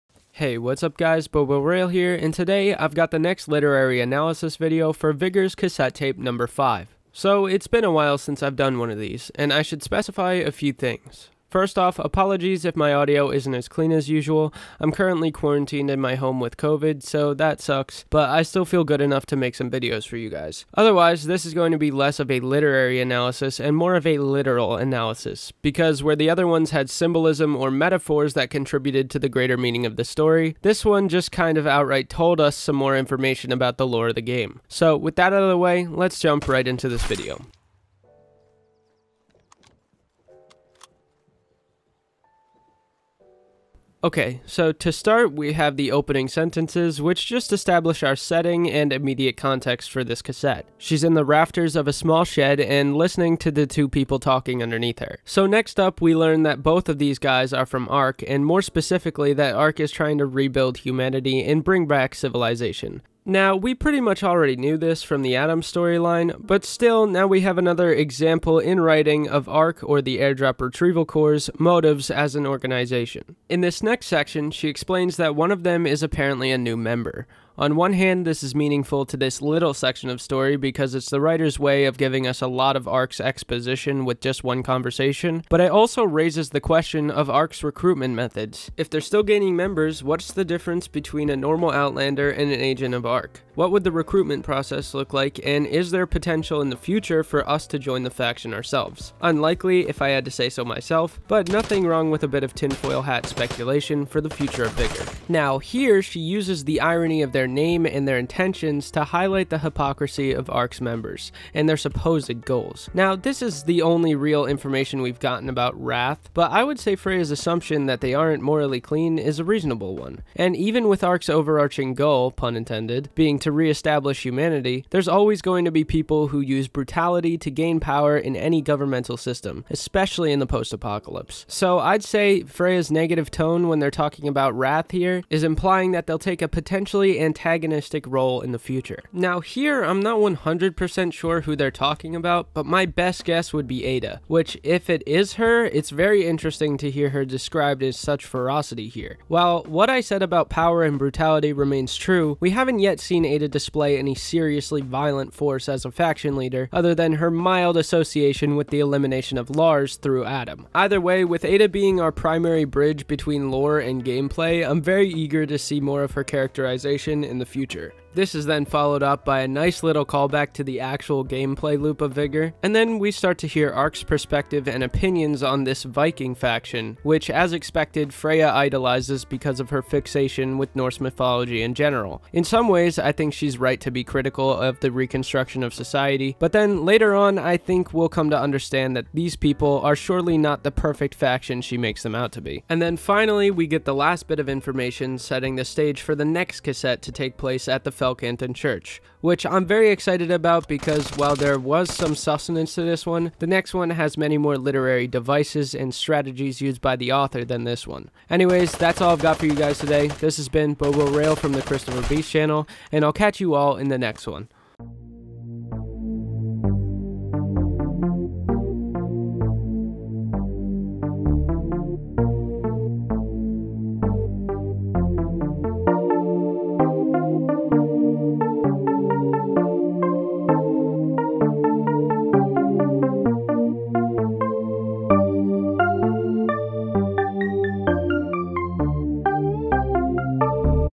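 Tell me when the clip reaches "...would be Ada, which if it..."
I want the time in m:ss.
2:23.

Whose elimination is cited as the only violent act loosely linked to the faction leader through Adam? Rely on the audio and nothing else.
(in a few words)
Lars.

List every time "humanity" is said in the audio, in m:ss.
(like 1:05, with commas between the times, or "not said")
1:00, 2:04.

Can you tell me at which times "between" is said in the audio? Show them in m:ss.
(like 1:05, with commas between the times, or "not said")
1:30, 2:43.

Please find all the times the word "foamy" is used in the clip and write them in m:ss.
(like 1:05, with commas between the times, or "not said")
not said.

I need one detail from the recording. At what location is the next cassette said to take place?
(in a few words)
Felcanton Church.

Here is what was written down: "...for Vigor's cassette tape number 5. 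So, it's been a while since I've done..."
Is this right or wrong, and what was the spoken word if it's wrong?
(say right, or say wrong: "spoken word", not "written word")
right.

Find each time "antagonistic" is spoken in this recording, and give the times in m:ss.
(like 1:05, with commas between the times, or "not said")
2:17.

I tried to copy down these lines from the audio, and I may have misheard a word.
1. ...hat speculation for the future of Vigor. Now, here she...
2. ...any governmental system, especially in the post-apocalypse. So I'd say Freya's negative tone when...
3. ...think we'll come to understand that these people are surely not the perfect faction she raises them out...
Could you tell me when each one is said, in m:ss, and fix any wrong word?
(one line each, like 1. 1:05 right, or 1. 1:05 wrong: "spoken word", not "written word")
1. 1:43 right
2. 2:08 right
3. 3:07 wrong: "makes", not "raises".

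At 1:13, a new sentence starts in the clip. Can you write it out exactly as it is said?
In this next section, she explains that one of them is apparently a new member.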